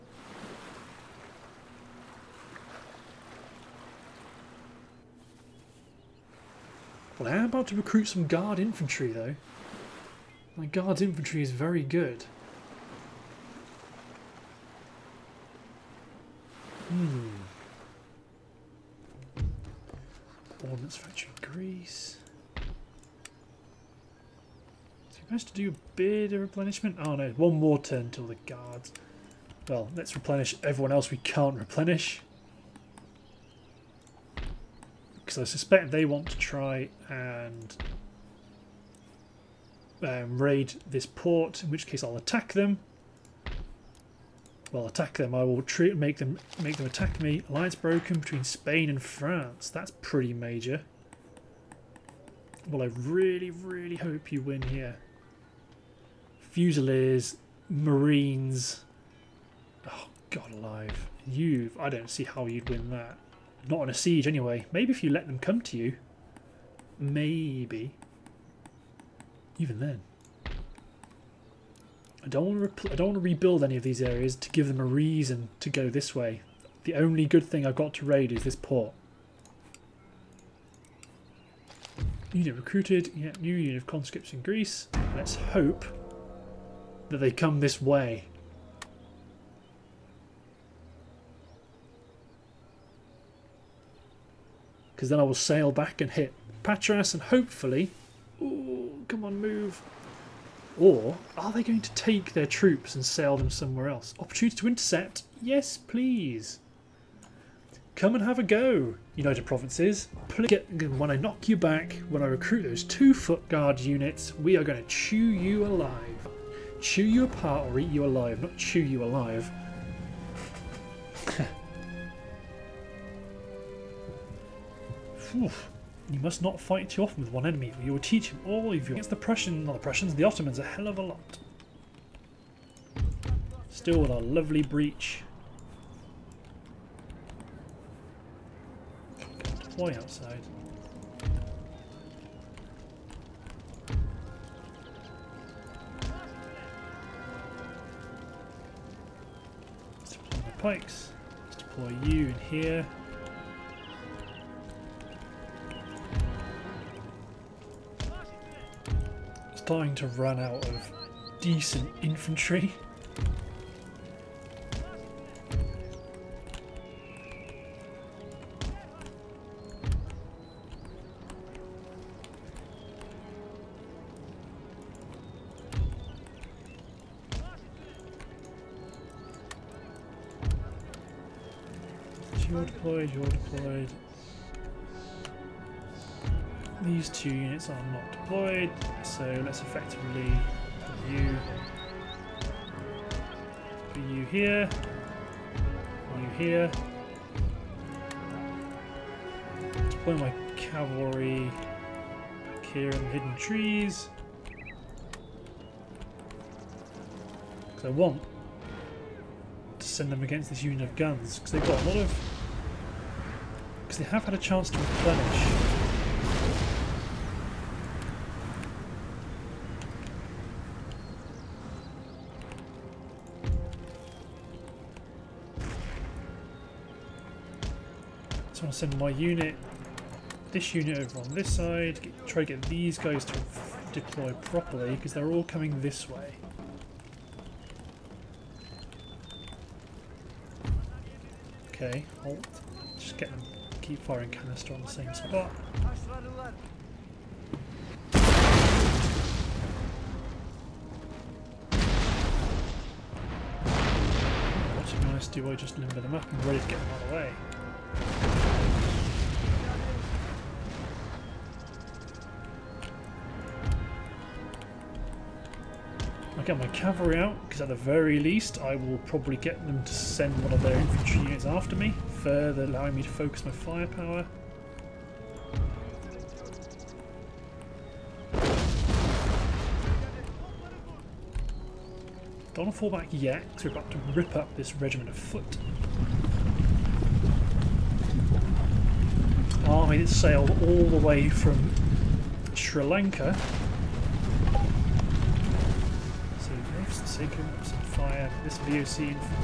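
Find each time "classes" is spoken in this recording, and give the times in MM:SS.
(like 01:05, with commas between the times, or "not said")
not said.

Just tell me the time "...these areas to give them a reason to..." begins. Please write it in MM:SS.
01:13.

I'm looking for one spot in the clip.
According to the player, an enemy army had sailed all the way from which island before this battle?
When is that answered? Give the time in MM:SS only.
04:52.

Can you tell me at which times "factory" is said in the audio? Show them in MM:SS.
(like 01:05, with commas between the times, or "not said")
00:20.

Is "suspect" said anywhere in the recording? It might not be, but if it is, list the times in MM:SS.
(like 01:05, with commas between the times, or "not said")
00:35.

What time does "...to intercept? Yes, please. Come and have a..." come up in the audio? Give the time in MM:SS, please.
01:44.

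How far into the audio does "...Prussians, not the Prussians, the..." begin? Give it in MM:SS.
02:09.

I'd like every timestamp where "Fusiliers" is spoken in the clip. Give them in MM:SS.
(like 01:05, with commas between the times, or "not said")
00:56.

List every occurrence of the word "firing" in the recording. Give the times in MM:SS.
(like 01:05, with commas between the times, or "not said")
04:03.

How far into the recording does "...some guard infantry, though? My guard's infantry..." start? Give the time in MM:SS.
00:08.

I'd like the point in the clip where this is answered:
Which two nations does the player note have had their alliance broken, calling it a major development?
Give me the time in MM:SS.
00:48.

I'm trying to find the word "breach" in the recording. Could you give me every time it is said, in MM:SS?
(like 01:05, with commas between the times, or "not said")
02:14.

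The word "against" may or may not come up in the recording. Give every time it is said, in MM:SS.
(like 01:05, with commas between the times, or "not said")
02:08, 03:30.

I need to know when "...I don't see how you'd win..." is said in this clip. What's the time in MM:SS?
01:01.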